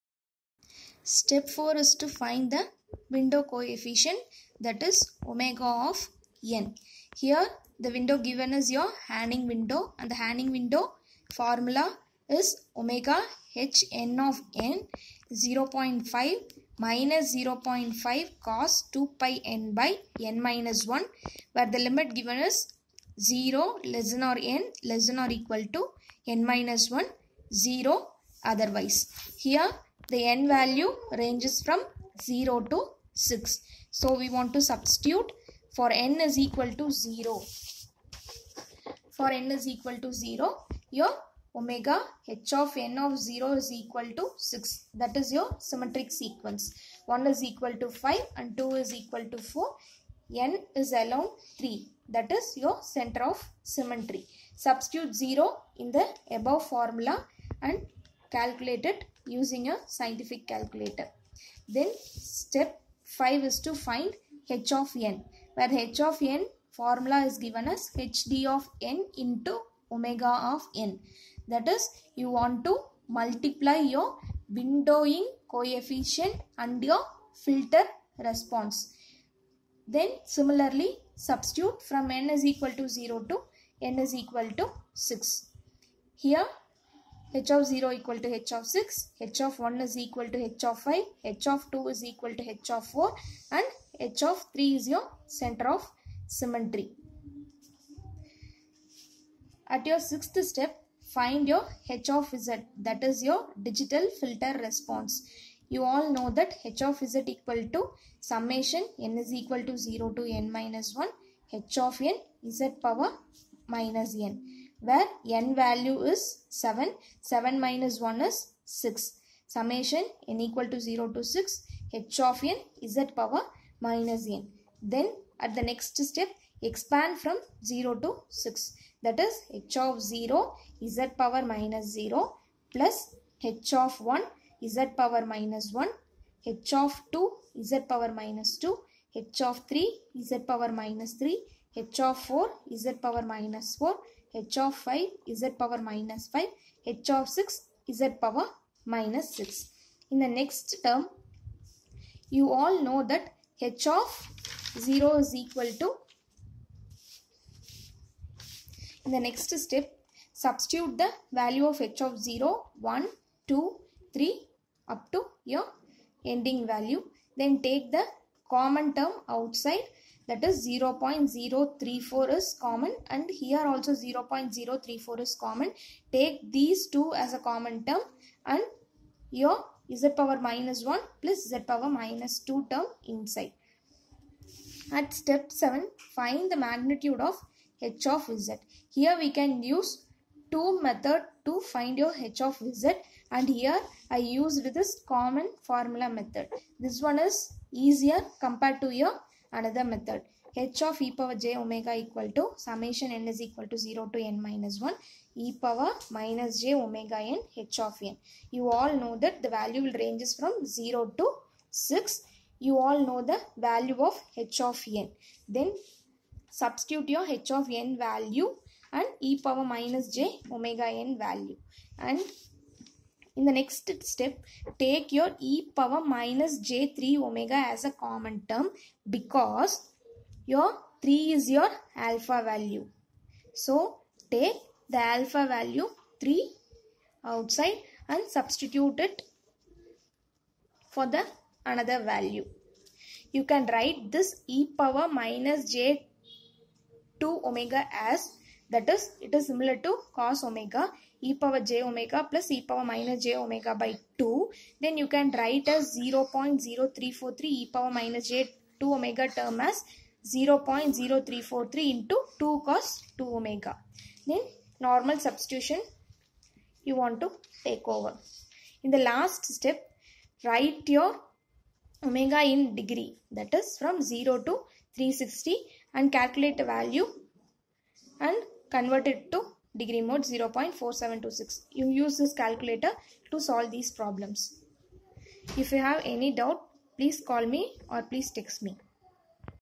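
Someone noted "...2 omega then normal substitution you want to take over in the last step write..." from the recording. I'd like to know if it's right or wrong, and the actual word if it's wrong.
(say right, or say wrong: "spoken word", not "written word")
right.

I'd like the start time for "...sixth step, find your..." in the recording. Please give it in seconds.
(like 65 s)
100 s.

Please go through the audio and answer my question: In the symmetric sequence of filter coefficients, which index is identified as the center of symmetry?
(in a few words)
3.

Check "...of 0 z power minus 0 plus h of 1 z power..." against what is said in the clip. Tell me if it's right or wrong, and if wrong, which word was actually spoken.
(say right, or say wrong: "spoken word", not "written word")
right.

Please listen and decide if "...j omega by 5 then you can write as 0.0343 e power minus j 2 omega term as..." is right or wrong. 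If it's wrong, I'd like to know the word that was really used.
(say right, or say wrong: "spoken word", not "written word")
wrong: "2", not "5".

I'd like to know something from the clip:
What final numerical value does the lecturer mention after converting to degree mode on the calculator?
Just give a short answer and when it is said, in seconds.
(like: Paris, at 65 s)
0.4726, at 280 s.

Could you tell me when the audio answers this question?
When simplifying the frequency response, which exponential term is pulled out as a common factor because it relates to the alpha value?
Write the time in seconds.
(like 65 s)
225 s.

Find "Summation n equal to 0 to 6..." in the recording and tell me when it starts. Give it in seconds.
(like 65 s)
119 s.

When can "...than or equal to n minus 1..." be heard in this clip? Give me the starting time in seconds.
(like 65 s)
25 s.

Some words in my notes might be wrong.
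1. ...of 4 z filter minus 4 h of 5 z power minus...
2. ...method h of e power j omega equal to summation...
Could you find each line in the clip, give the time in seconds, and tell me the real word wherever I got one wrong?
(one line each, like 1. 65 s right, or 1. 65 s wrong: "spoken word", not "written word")
1. 142 s wrong: "power", not "filter"
2. 199 s right.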